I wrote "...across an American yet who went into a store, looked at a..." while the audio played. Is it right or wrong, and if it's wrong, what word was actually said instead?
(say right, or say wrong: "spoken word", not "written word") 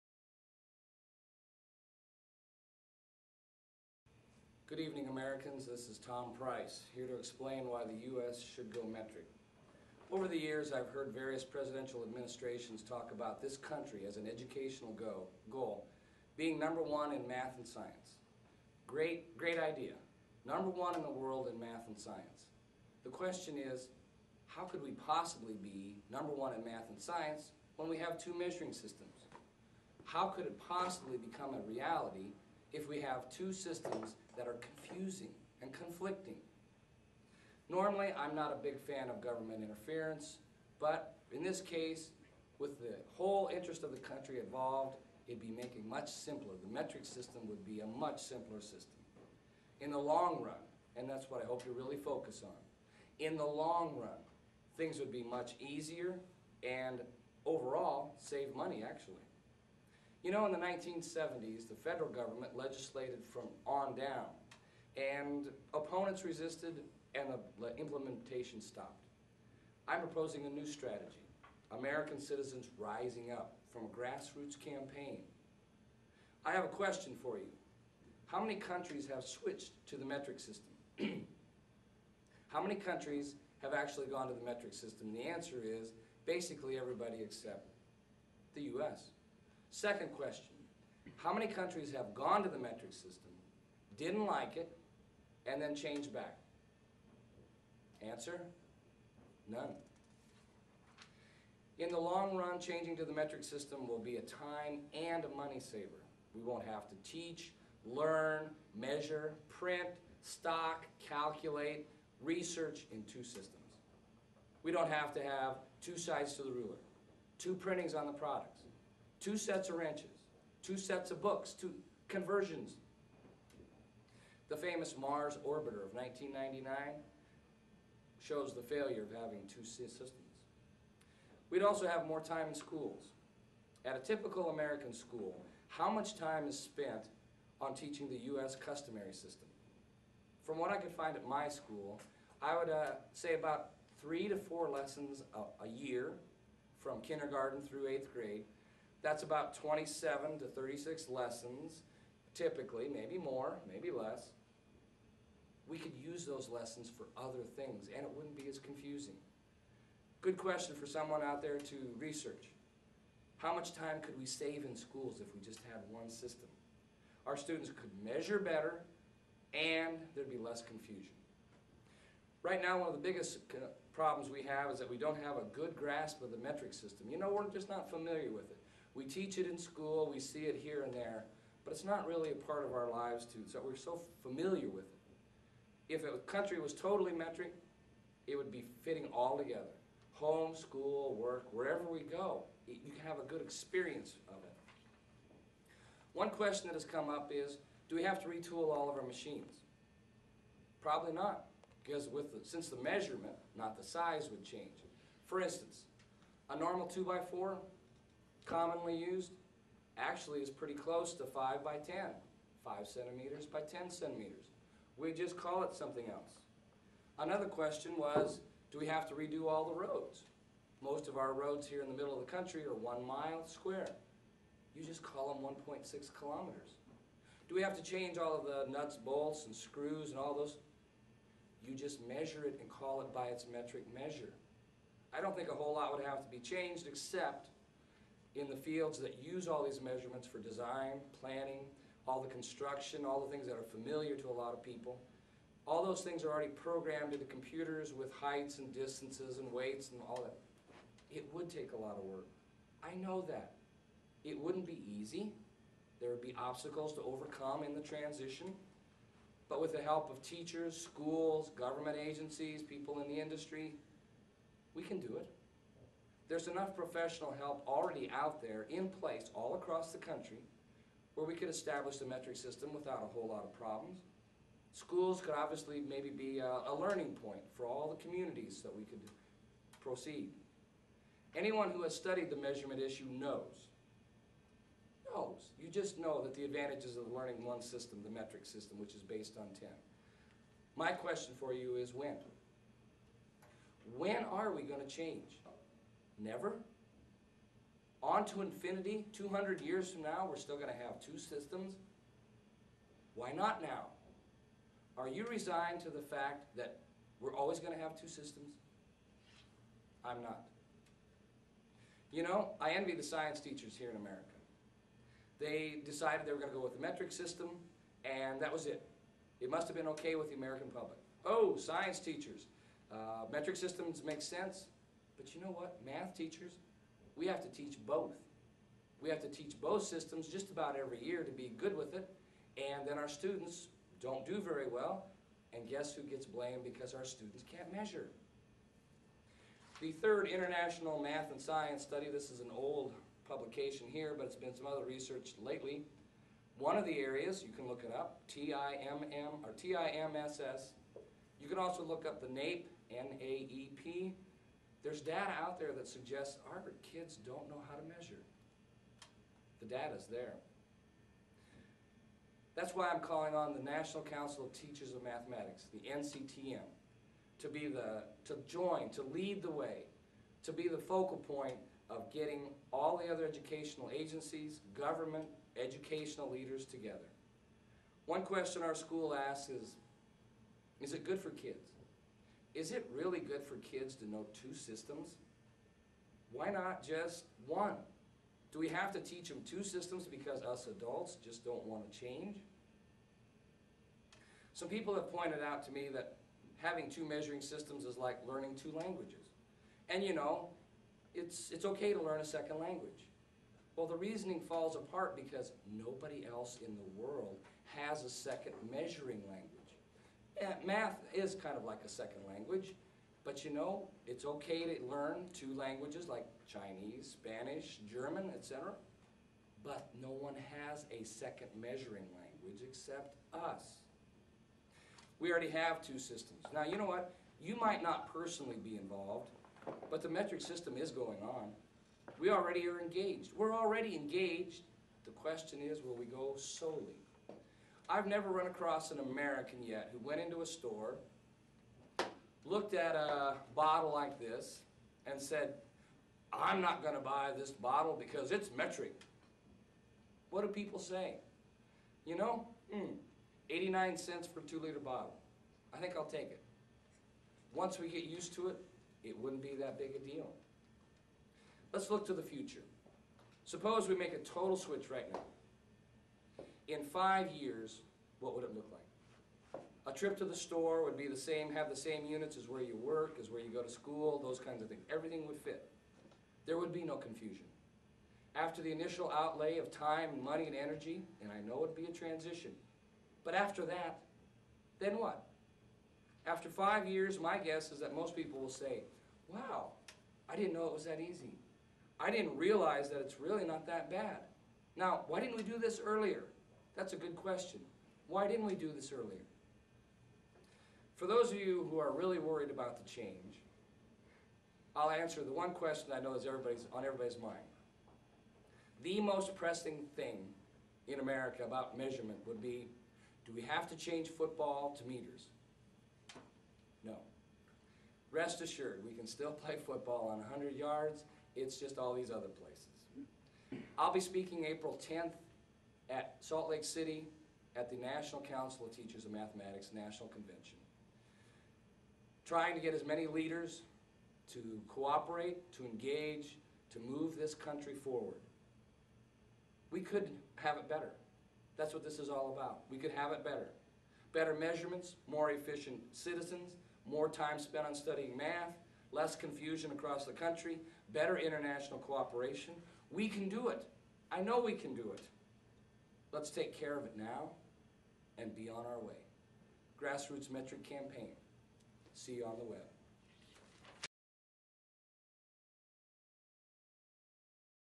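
right.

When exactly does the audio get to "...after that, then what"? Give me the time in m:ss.
8:03.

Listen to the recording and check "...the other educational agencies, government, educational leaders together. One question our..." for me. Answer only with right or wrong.
right.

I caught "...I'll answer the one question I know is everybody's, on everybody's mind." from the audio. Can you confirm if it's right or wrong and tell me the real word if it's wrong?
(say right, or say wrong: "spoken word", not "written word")
right.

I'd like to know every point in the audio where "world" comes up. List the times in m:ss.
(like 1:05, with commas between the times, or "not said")
0:21, 6:47.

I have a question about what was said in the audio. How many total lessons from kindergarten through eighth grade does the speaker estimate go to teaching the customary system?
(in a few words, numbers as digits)
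27 to 36.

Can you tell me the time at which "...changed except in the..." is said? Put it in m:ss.
3:56.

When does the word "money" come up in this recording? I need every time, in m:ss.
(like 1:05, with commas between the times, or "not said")
0:58, 1:45, 8:00.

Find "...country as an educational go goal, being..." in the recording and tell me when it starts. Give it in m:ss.
0:13.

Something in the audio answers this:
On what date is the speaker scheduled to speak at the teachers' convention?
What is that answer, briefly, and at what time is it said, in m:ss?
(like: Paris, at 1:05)
April 10th, at 8:44.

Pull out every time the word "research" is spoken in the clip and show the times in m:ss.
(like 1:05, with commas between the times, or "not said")
1:52, 2:41, 5:44.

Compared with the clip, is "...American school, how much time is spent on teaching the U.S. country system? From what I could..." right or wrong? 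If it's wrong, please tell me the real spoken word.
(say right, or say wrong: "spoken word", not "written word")
wrong: "customary", not "country".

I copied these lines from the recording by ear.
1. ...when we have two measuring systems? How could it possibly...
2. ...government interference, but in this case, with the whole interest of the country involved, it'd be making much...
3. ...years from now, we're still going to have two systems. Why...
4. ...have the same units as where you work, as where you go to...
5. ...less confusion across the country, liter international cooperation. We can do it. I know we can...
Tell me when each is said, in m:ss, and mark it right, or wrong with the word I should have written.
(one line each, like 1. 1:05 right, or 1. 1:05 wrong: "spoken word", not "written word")
1. 0:27 right
2. 0:39 right
3. 4:59 right
4. 7:51 right
5. 9:08 wrong: "better", not "liter".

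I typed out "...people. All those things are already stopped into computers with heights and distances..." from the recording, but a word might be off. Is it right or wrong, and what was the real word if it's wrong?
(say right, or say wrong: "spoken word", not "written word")
wrong: "programmed", not "stopped".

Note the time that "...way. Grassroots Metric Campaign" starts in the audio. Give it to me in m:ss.
9:18.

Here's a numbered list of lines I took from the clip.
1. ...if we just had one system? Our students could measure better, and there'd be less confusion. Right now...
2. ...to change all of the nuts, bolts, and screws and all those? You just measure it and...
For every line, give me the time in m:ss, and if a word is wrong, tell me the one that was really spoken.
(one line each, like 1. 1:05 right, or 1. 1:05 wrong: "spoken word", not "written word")
1. 2:45 right
2. 3:47 right.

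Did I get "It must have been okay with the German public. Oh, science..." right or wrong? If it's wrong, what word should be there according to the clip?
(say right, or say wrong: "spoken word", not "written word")
wrong: "American", not "German".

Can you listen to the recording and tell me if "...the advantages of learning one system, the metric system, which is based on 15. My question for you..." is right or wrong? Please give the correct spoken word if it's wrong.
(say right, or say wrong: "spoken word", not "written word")
wrong: "10", not "15".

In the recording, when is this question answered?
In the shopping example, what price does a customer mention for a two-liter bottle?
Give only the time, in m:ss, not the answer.
7:33.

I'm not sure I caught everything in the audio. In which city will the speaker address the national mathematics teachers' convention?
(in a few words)
Salt Lake City.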